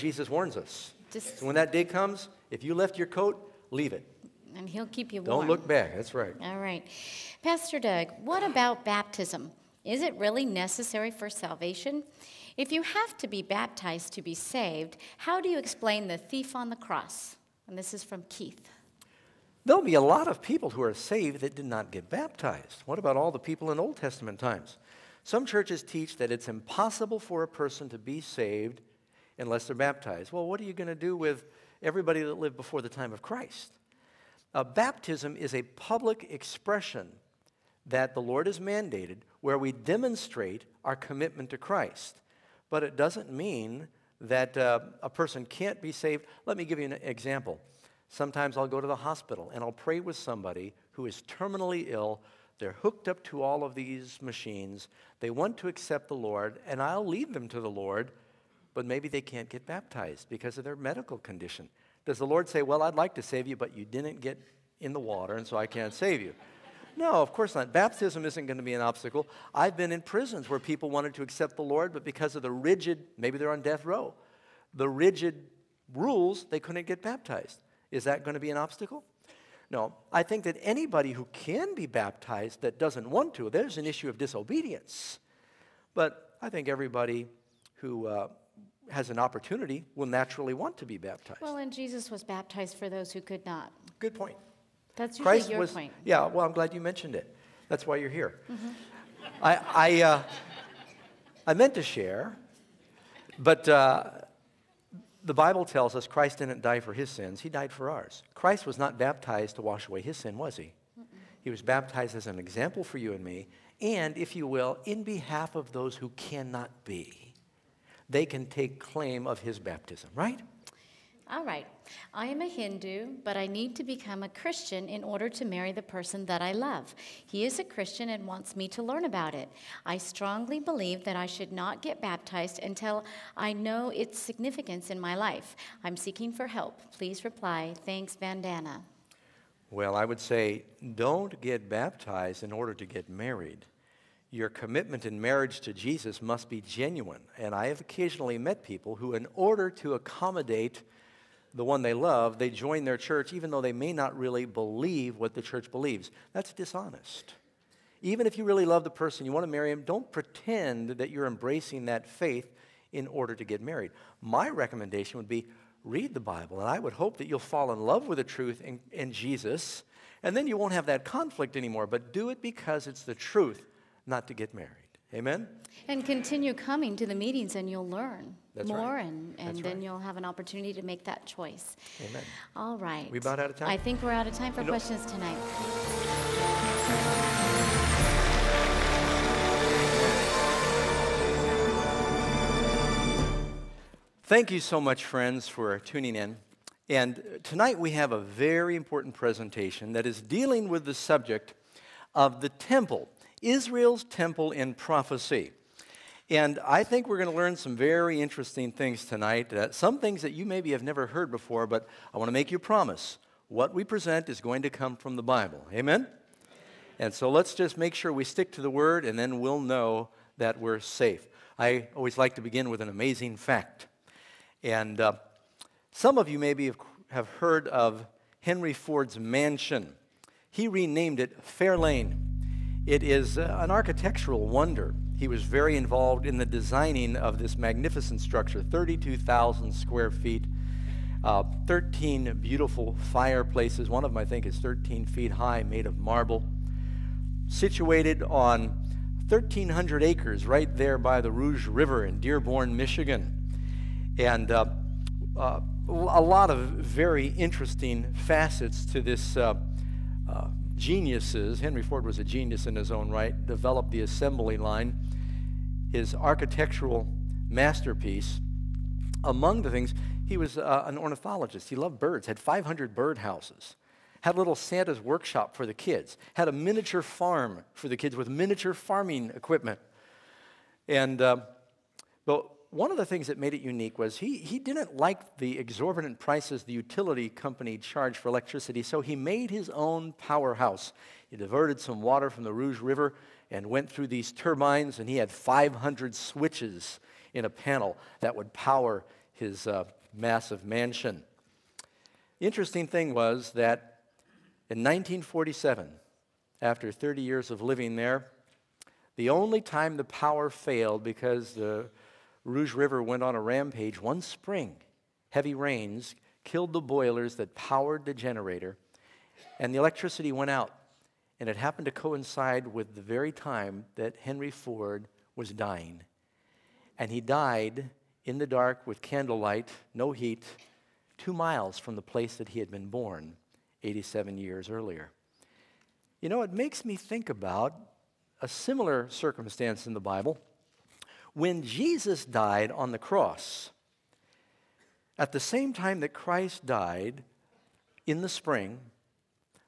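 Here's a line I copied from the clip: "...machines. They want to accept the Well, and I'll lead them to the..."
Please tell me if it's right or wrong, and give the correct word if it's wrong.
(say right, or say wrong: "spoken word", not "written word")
wrong: "Lord", not "Well".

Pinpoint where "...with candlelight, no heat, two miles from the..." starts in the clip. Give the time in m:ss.
5:28.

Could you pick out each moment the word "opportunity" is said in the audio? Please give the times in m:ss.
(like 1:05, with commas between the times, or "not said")
1:29, 3:00.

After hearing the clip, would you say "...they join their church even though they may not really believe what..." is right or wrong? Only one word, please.
right.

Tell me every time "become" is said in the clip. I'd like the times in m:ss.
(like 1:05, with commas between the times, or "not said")
2:03.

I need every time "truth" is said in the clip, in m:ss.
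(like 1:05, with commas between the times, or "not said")
2:48, 2:53.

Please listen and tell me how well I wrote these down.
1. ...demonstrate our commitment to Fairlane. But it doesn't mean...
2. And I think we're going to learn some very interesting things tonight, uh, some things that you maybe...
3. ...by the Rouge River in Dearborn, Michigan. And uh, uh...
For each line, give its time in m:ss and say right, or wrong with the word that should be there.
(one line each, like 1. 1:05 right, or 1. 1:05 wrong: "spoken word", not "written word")
1. 0:39 wrong: "Christ", not "Fairlane"
2. 3:26 right
3. 4:10 right.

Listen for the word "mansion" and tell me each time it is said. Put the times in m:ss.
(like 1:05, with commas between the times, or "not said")
3:49, 5:00.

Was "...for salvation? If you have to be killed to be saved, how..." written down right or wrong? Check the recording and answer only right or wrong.
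wrong.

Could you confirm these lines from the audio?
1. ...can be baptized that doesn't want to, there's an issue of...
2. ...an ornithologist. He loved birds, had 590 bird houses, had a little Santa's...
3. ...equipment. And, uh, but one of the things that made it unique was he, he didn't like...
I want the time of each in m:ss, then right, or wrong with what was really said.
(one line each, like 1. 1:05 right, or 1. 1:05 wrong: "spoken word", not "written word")
1. 1:21 right
2. 4:30 wrong: "500", not "590"
3. 4:39 right.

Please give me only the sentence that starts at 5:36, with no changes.
You know, it makes me think about a similar circumstance in the Bible.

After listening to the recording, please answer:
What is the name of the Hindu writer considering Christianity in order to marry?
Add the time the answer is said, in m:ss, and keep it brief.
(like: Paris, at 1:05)
Bandana, at 2:18.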